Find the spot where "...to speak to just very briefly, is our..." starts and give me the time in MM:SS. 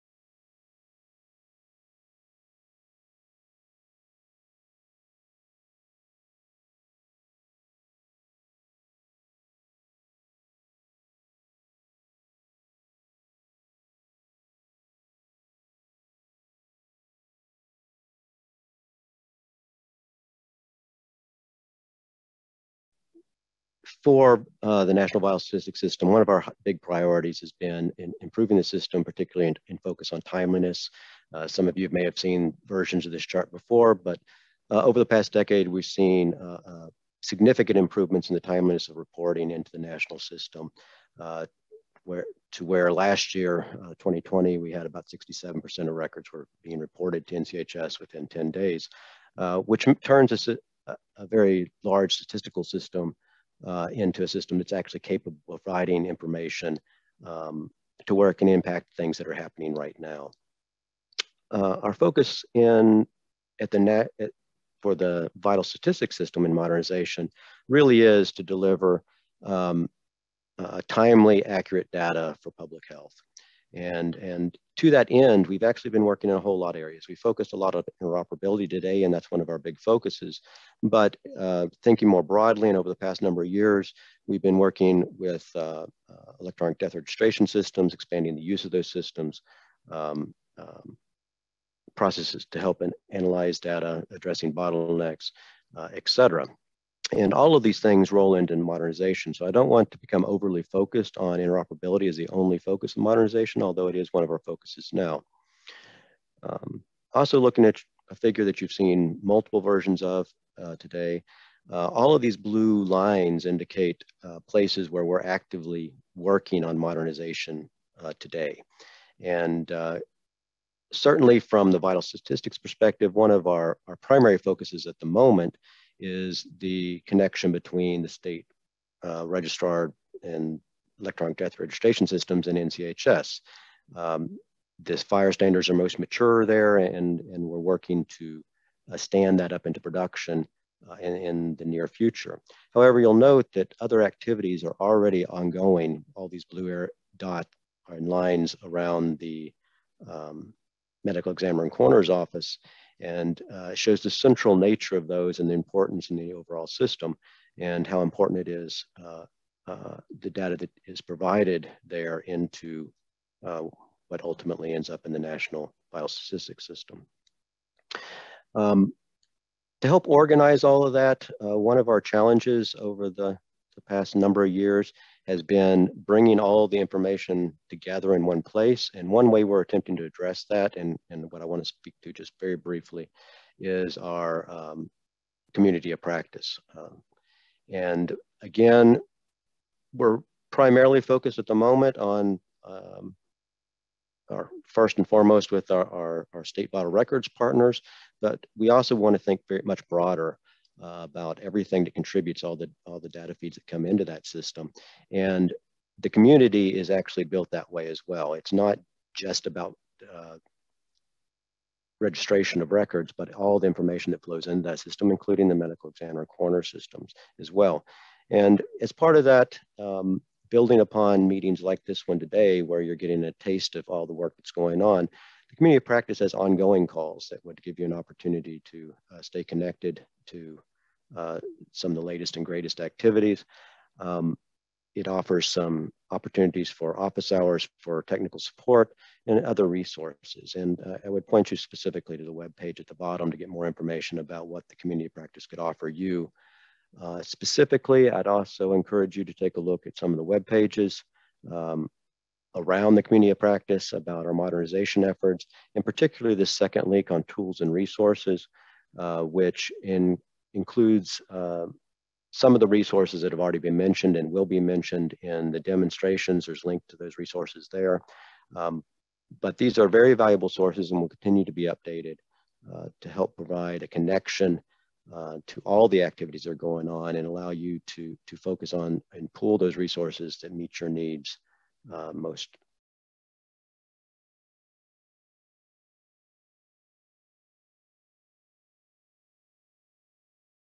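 03:01.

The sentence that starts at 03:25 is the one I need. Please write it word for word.
And the community is actually built that way as well.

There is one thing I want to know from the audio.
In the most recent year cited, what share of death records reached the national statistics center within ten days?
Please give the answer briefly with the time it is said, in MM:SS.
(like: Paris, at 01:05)
67%, at 00:45.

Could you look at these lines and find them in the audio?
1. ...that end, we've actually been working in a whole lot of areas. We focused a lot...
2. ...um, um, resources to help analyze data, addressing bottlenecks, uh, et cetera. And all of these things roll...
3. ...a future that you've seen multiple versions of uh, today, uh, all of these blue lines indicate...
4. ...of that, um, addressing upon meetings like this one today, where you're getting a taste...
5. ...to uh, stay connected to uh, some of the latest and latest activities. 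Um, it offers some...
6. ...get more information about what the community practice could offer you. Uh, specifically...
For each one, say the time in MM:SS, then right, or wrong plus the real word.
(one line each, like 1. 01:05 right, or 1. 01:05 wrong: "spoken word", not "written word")
1. 01:14 right
2. 01:29 wrong: "processes", not "resources"
3. 01:48 wrong: "figure", not "future"
4. 03:39 wrong: "building", not "addressing"
5. 03:48 wrong: "greatest", not "latest"
6. 04:03 right.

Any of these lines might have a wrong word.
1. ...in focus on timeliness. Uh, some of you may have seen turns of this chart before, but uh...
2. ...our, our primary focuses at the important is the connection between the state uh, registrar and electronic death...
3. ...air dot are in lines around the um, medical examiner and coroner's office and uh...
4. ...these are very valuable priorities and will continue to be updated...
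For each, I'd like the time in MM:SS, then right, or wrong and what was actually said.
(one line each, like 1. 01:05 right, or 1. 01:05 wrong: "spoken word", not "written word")
1. 00:29 wrong: "versions", not "turns"
2. 02:03 wrong: "moment", not "important"
3. 02:26 right
4. 04:29 wrong: "sources", not "priorities".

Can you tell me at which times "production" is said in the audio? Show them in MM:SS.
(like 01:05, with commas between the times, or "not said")
02:19.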